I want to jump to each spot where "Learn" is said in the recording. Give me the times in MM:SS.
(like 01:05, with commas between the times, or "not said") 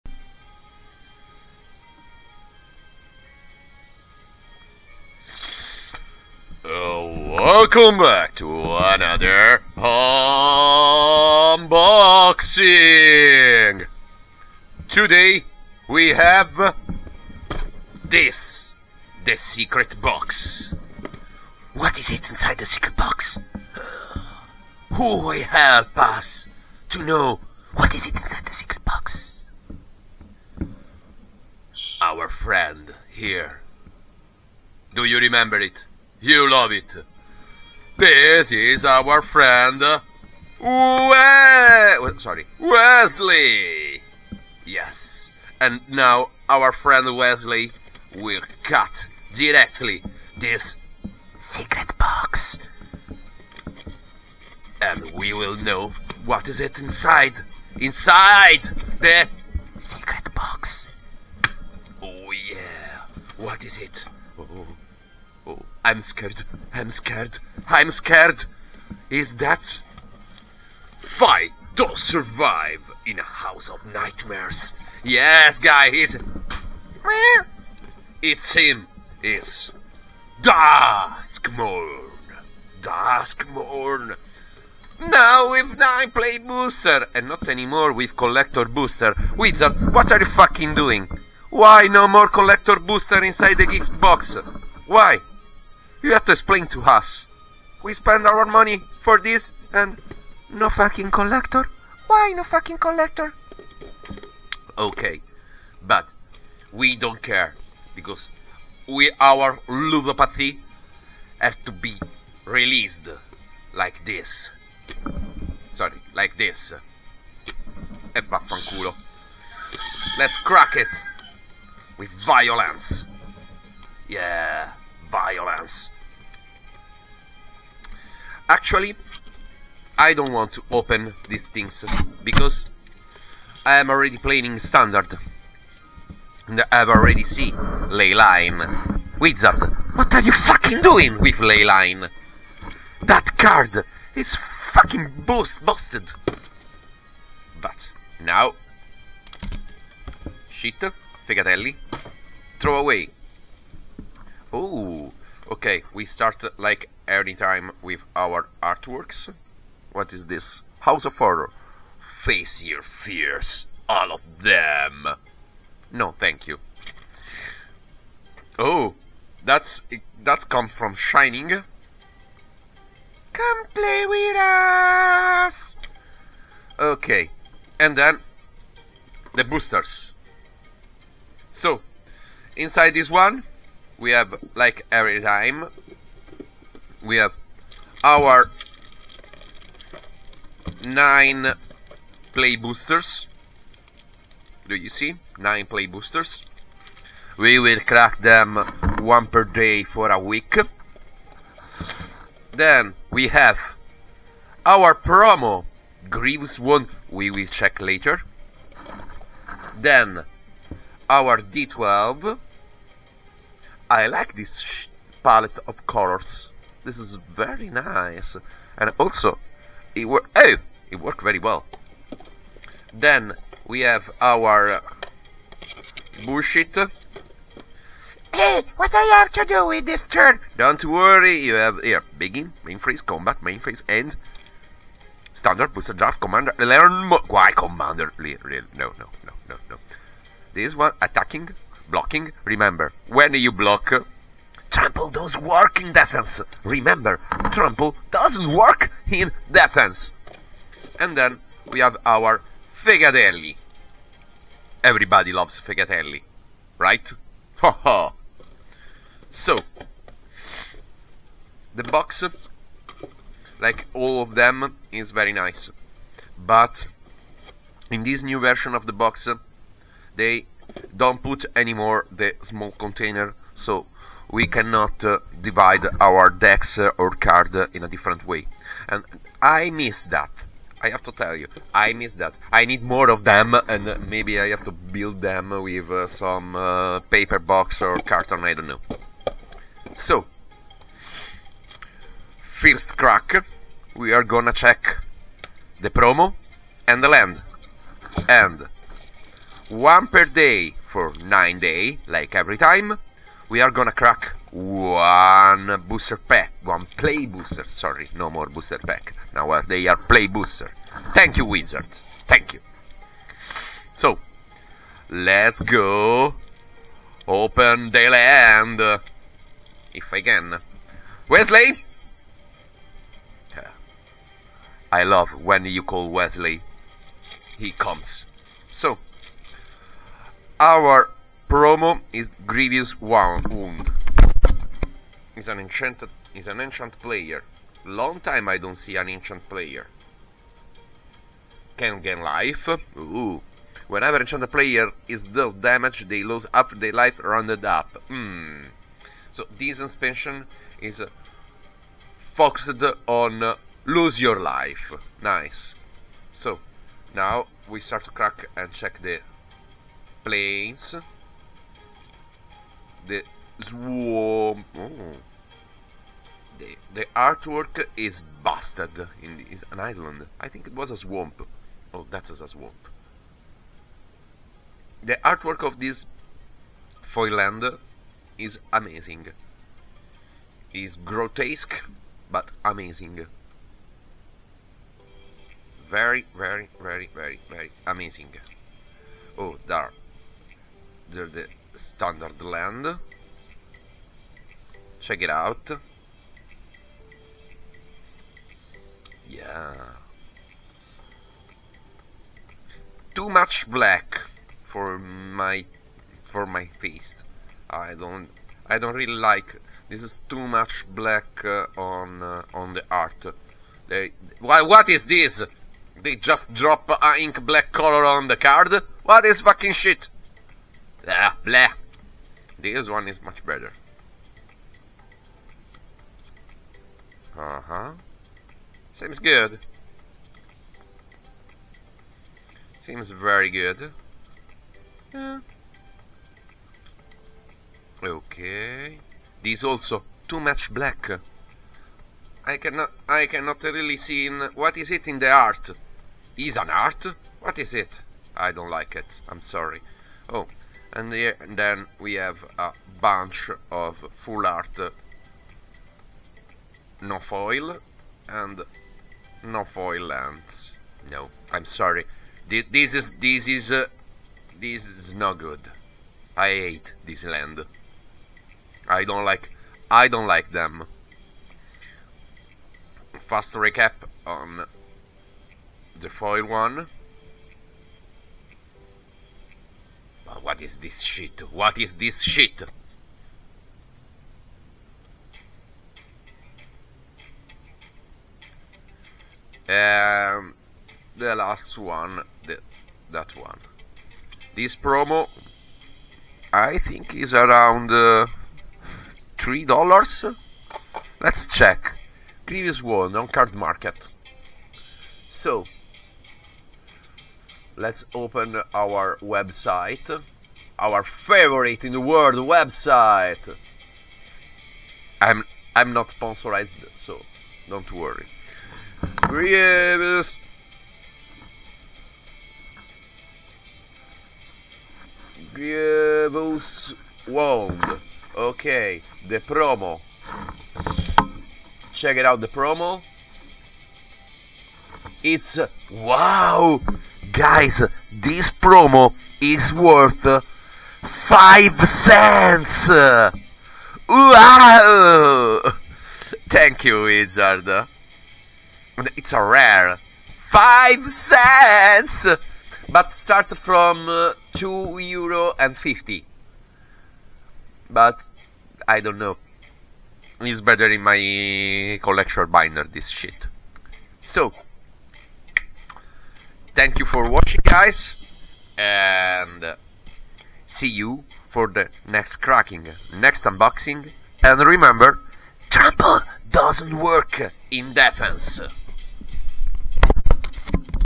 03:56.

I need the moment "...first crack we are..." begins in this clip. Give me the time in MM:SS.
04:52.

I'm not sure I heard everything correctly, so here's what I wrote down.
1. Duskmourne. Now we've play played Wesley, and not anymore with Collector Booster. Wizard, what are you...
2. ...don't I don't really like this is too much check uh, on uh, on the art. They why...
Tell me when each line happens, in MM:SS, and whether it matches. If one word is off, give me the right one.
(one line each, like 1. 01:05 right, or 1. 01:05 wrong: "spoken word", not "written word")
1. 01:22 wrong: "Booster", not "Wesley"
2. 06:47 wrong: "black", not "check".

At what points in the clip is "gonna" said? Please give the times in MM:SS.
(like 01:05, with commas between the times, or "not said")
04:54, 05:03.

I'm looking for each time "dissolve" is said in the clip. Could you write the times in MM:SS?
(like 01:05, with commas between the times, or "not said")
not said.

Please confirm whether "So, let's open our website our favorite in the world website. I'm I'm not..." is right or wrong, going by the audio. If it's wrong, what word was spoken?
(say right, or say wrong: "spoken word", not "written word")
right.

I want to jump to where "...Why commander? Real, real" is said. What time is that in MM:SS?
03:57.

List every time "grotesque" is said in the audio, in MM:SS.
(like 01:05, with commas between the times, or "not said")
06:21.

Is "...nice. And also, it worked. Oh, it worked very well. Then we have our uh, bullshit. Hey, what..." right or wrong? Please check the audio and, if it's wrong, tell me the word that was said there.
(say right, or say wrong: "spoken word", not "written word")
right.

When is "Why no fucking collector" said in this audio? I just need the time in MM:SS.
01:42.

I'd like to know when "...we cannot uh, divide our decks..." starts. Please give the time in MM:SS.
04:34.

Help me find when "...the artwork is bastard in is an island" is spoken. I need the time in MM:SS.
06:06.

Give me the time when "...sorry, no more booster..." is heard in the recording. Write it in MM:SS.
05:07.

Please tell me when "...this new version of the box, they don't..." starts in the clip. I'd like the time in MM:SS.
04:28.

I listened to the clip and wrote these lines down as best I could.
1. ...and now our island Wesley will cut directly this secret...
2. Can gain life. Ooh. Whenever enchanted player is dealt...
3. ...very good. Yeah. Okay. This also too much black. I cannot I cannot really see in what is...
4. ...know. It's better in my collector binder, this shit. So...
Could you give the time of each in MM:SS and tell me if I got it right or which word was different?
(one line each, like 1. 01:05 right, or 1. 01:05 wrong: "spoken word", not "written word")
1. 00:45 wrong: "friend", not "island"
2. 05:41 right
3. 07:13 right
4. 09:19 right.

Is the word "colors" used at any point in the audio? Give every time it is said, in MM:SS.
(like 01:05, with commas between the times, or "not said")
03:35, 06:57.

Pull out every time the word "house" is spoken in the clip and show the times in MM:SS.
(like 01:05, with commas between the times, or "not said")
01:13, 02:40.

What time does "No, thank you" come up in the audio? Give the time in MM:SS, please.
02:45.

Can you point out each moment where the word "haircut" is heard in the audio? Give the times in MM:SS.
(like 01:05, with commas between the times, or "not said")
not said.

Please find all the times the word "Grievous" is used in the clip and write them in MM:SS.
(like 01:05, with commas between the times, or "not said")
03:26, 05:32, 08:22, 08:45.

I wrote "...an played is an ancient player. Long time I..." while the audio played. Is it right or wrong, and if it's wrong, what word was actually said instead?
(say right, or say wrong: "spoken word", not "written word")
wrong: "enchanted", not "played".